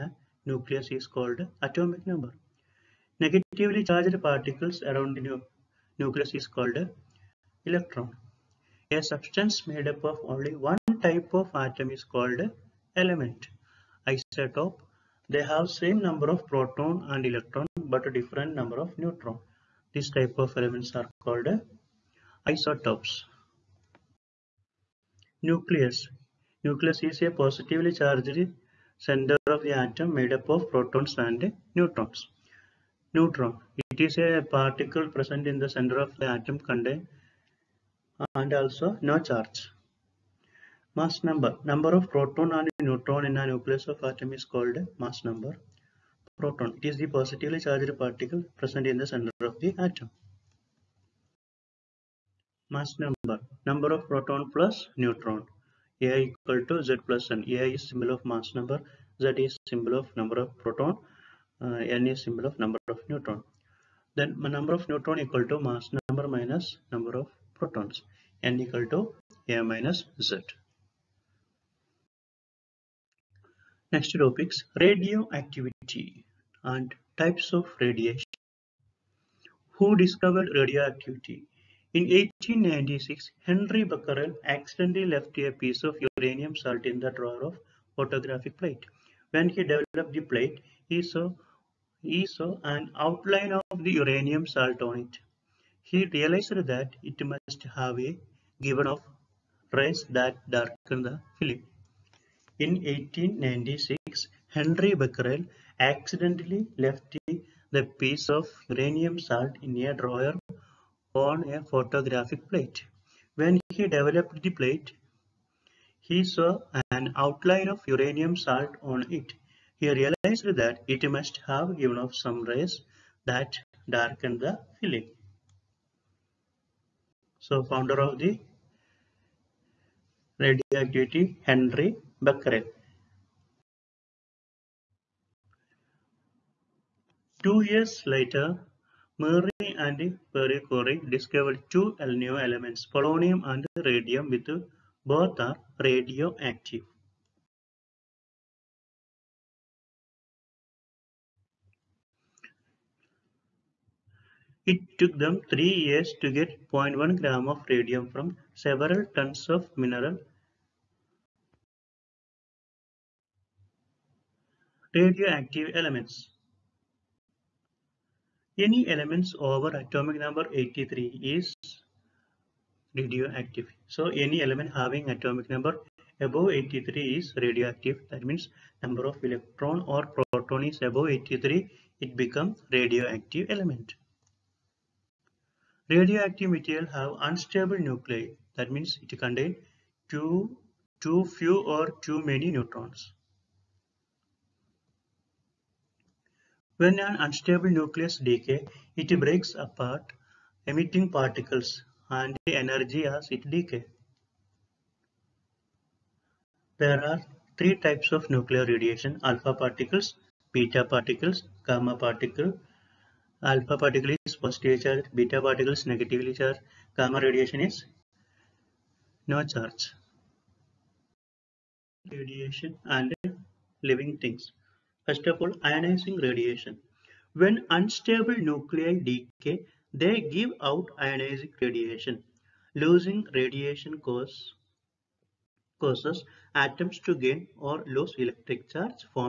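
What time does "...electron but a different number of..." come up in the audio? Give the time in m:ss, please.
0:17.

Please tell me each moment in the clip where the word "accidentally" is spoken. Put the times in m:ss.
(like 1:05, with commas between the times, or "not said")
1:24, 1:45.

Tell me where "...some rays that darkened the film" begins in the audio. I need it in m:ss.
2:02.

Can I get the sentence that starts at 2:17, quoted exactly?
Two years later, Marie and Pierre Curie discovered two new elements, polonium and radium, with both are radioactive.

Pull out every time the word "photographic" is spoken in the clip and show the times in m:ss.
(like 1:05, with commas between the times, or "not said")
1:27, 1:51.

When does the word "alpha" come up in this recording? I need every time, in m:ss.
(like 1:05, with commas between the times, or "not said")
3:29, 3:33.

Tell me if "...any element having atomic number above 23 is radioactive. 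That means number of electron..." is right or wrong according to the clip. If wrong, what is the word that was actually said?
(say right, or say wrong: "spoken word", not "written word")
wrong: "83", not "23".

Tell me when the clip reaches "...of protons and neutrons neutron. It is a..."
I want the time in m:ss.
0:30.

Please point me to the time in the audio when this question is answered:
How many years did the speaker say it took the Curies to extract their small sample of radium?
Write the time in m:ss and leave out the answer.
2:35.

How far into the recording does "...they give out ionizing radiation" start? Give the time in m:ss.
3:49.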